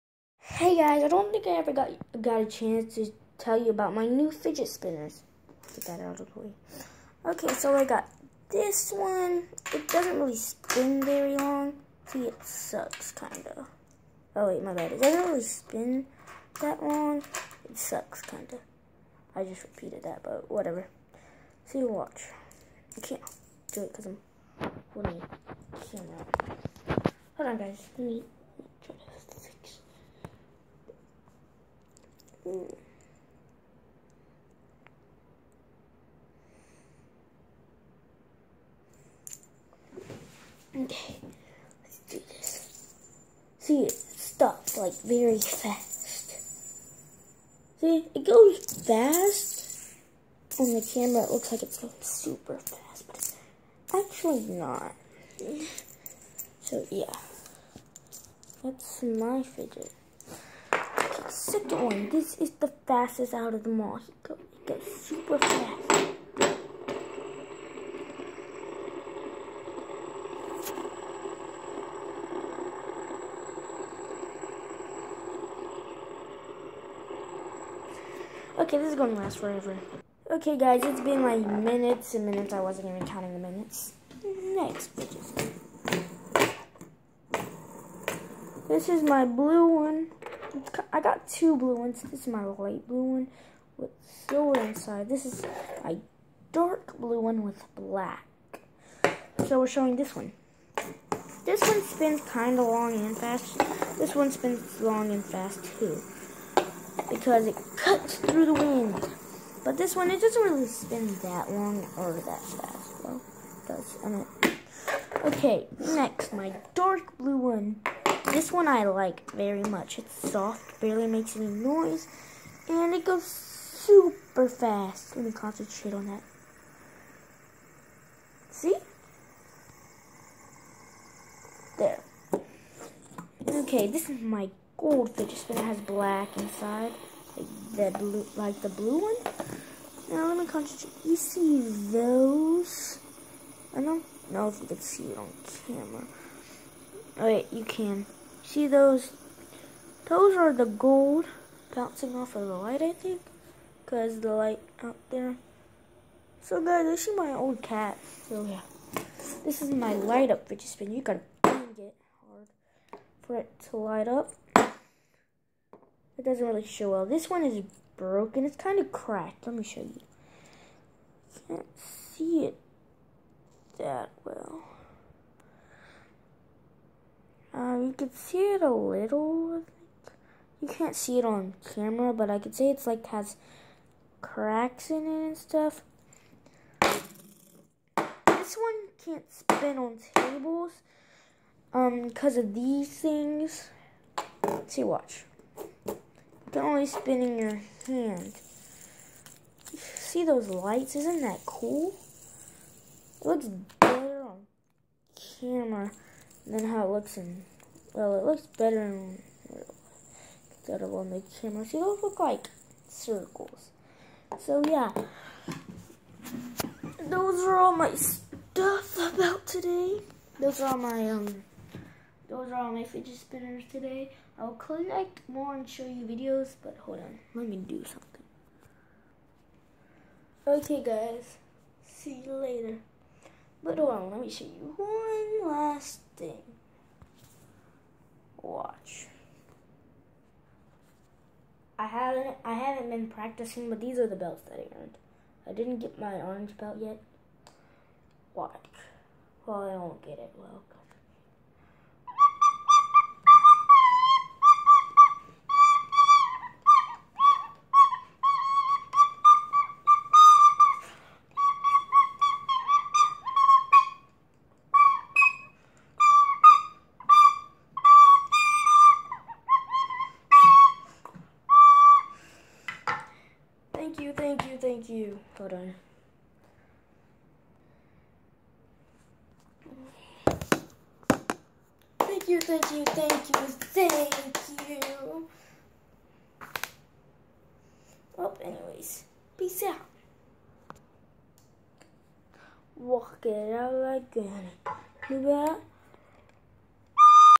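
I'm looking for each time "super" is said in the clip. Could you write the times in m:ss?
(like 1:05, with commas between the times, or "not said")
0:52, 1:05, 2:03.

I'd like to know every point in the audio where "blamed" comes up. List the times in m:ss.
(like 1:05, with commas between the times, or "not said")
not said.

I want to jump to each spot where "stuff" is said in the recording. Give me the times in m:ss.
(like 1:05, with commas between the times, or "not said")
3:05, 3:37.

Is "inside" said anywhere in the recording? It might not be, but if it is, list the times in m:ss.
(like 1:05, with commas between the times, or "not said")
1:34, 2:16.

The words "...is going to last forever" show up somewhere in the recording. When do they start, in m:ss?
1:18.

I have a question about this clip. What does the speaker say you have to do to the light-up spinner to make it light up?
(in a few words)
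Bang it hard.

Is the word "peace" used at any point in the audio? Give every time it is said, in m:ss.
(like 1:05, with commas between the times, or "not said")
4:49.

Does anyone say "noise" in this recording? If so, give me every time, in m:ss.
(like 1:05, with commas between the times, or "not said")
2:01.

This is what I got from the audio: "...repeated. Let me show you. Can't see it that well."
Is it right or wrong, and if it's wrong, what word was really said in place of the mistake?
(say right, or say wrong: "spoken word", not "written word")
wrong: "cracked", not "repeated".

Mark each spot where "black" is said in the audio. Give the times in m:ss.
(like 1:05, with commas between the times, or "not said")
1:37, 2:15.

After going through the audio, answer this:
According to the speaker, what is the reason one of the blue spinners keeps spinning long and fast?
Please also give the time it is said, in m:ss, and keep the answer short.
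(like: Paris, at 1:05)
It cuts through the wind, at 1:47.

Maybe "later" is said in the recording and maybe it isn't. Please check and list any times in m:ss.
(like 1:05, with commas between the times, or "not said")
3:52.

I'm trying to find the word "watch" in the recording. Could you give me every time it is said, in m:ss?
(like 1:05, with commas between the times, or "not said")
0:21, 3:14, 3:58, 4:08.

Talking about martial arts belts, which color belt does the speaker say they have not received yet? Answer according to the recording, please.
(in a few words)
Orange.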